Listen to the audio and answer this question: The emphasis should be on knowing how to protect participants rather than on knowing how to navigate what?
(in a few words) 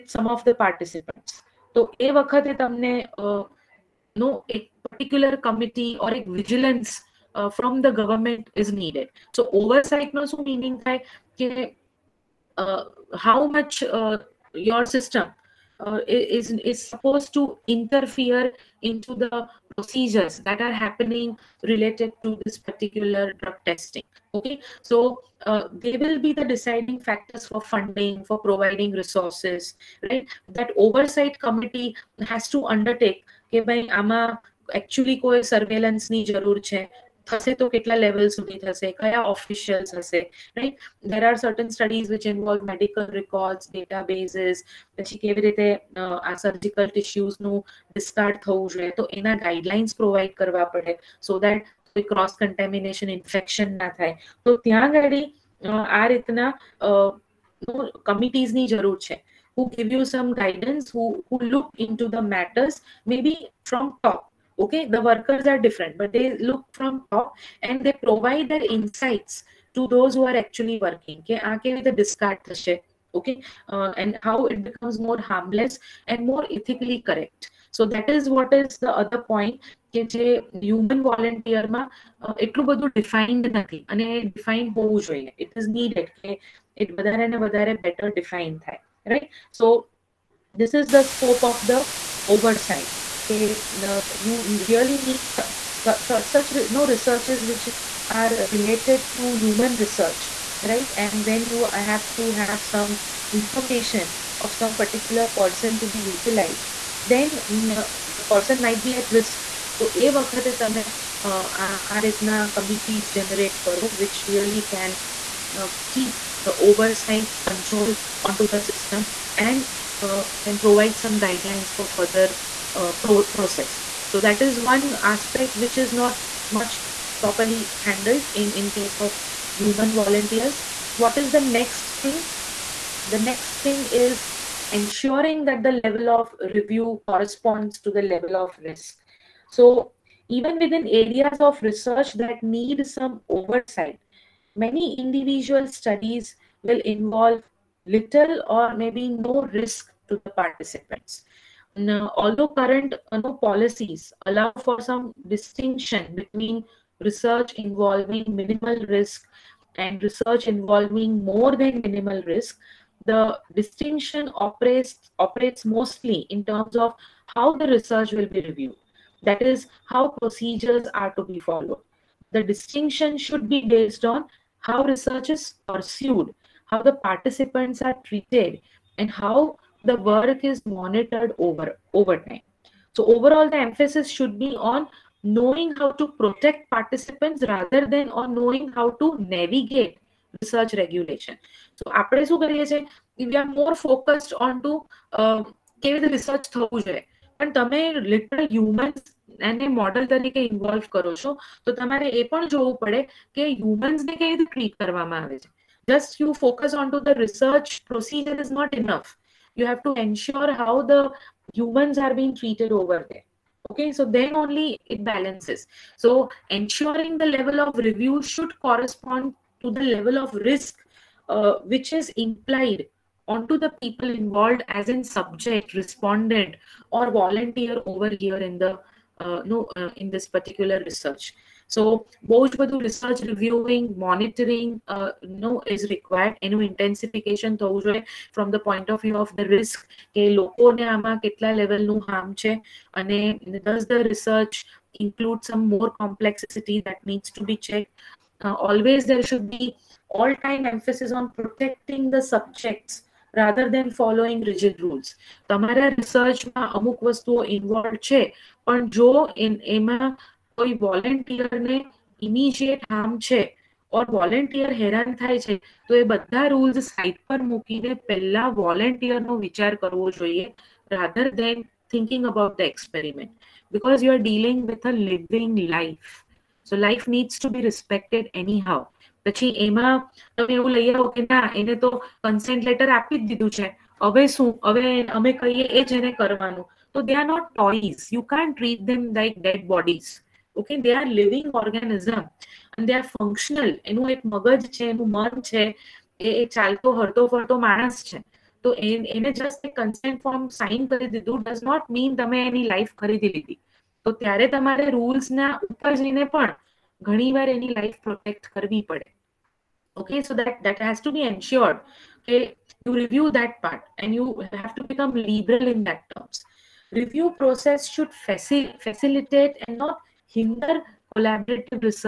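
research regulation.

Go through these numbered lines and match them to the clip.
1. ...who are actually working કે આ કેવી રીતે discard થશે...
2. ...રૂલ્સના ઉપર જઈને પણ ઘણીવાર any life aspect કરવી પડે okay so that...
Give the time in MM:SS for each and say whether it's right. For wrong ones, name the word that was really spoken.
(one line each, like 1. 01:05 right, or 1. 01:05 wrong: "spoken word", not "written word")
1. 01:10 right
2. 05:04 wrong: "protect", not "aspect".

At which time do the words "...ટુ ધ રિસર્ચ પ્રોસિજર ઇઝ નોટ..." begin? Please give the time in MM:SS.
03:26.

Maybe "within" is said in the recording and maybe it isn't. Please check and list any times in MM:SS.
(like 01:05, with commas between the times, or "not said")
02:20.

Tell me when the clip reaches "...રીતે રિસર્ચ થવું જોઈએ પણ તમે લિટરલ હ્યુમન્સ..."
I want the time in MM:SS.
03:16.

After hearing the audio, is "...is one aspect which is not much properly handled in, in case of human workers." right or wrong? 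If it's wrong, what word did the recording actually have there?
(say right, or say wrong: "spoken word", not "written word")
wrong: "volunteers", not "workers".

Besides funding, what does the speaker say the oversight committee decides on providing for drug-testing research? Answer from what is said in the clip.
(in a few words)
resources.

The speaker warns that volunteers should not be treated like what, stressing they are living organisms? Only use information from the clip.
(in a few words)
dead bodies.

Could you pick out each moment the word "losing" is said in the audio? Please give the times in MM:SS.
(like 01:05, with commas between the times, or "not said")
not said.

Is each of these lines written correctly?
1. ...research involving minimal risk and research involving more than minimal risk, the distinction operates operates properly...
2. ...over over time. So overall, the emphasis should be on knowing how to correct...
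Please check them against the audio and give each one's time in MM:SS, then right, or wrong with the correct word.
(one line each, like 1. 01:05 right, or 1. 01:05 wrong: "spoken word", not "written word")
1. 02:37 wrong: "mostly", not "properly"
2. 03:01 wrong: "protect", not "correct".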